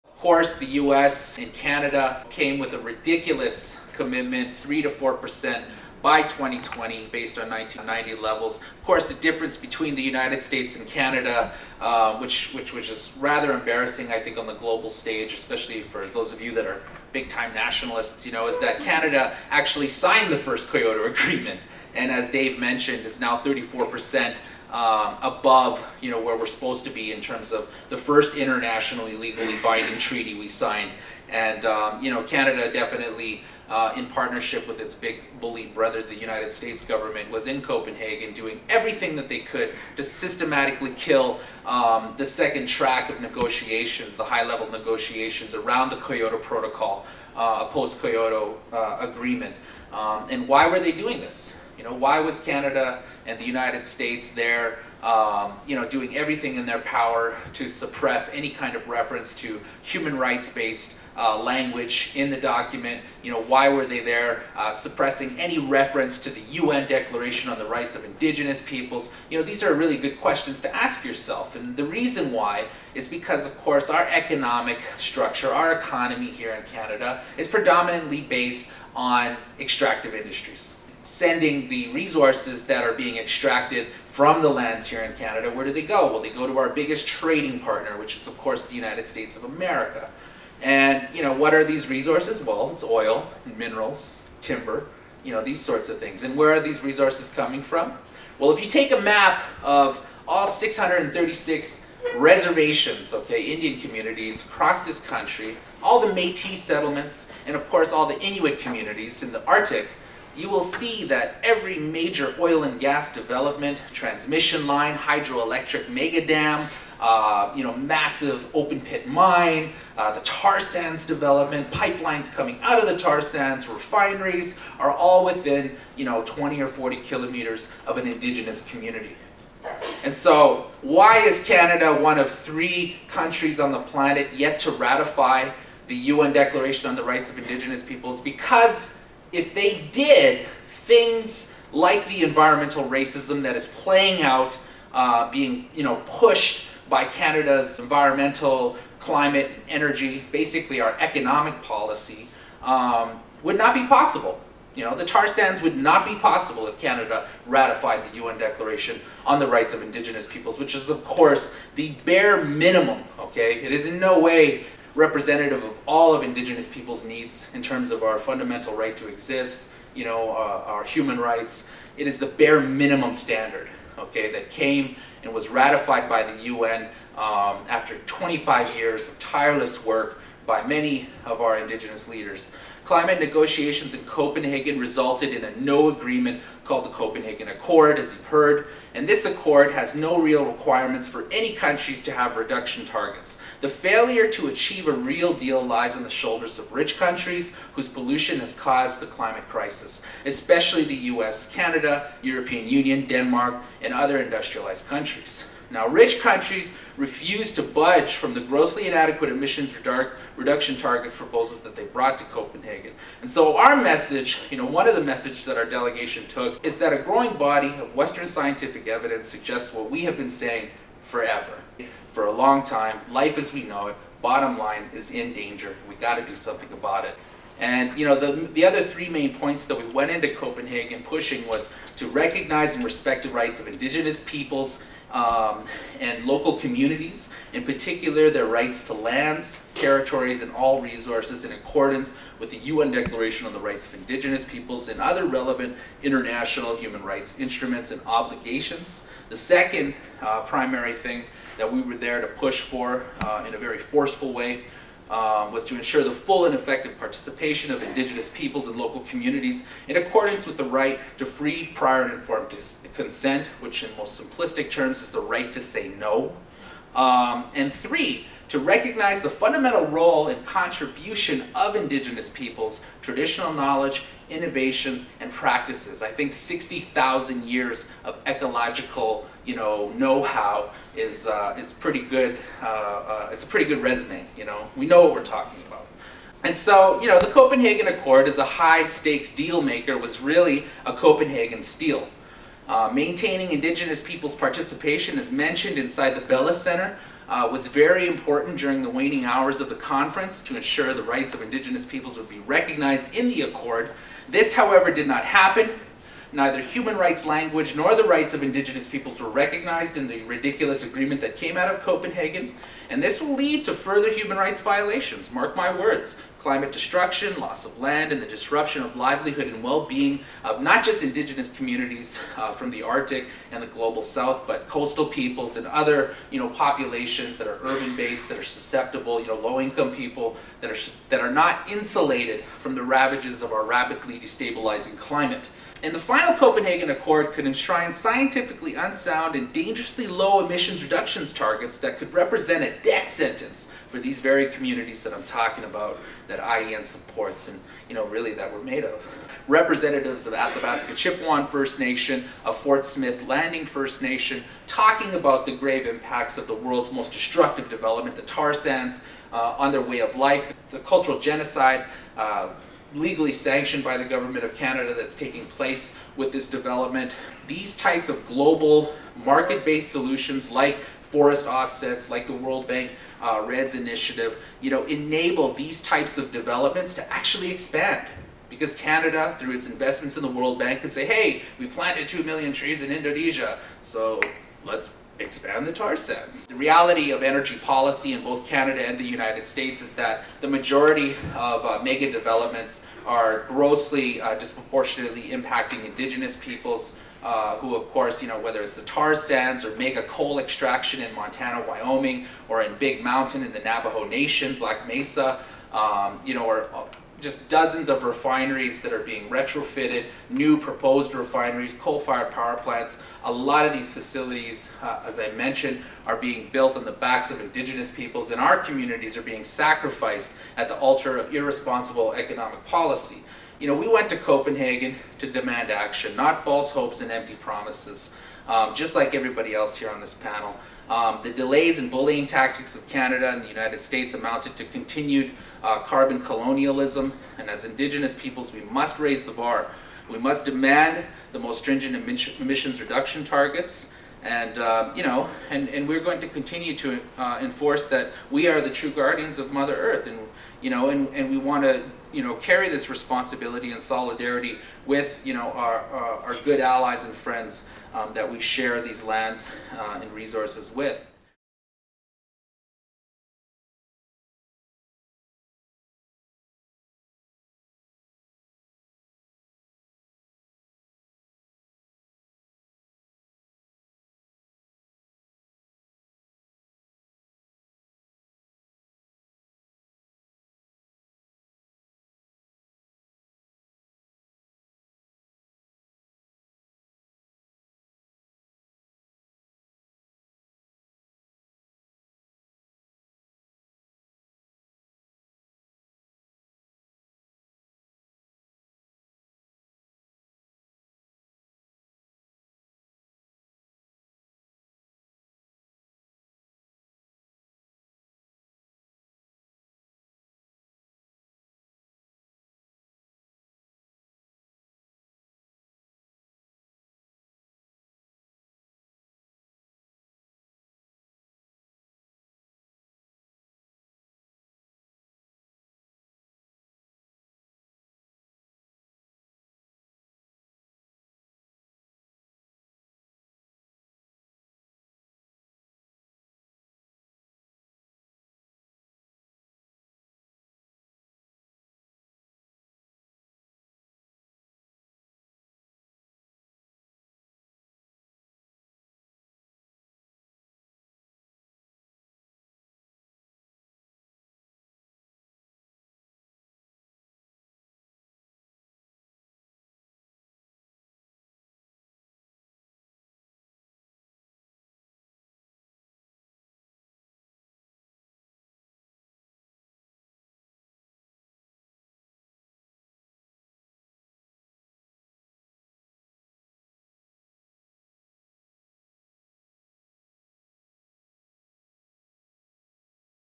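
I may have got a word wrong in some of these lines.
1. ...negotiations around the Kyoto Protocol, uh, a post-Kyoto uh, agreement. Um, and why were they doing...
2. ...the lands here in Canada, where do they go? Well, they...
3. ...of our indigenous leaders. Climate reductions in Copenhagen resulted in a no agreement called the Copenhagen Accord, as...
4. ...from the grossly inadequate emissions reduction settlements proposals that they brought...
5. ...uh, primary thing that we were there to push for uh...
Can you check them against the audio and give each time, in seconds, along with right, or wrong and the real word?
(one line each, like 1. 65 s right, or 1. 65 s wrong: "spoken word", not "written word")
1. 44 s right
2. 84 s right
3. 181 s wrong: "negotiations", not "reductions"
4. 208 s wrong: "targets", not "settlements"
5. 250 s right.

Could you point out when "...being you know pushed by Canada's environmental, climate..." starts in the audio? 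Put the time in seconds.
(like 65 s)
145 s.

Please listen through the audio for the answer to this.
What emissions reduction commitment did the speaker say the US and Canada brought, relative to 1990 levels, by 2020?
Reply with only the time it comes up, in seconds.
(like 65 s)
4 s.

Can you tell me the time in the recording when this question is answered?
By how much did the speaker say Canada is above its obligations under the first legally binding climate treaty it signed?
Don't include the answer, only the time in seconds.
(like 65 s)
23 s.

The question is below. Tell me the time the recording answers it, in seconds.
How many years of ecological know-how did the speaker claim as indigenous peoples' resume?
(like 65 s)
276 s.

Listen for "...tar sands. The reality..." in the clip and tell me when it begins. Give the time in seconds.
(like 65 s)
385 s.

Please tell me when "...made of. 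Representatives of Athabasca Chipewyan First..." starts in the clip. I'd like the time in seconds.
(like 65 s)
348 s.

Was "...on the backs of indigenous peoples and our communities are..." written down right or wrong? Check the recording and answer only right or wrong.
right.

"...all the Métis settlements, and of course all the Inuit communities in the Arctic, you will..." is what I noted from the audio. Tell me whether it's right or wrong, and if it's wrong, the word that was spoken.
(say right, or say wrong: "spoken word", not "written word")
right.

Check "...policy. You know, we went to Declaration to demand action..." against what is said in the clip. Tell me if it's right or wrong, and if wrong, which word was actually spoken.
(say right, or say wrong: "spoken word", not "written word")
wrong: "Copenhagen", not "Declaration".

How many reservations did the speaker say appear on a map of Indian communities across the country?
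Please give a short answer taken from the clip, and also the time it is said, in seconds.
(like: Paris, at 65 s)
636, at 100 s.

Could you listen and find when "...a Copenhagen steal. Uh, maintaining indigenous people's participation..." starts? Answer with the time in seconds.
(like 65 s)
290 s.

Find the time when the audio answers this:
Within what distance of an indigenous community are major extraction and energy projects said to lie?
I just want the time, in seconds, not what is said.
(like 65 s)
126 s.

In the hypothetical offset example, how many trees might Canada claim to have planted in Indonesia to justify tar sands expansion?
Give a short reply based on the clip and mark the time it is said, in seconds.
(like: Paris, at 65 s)
2 million, at 382 s.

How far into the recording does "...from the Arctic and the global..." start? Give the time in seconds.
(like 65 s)
322 s.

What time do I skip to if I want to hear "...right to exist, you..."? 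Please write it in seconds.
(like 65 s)
168 s.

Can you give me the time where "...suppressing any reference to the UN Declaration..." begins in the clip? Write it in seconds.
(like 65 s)
64 s.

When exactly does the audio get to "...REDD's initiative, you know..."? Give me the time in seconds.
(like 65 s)
373 s.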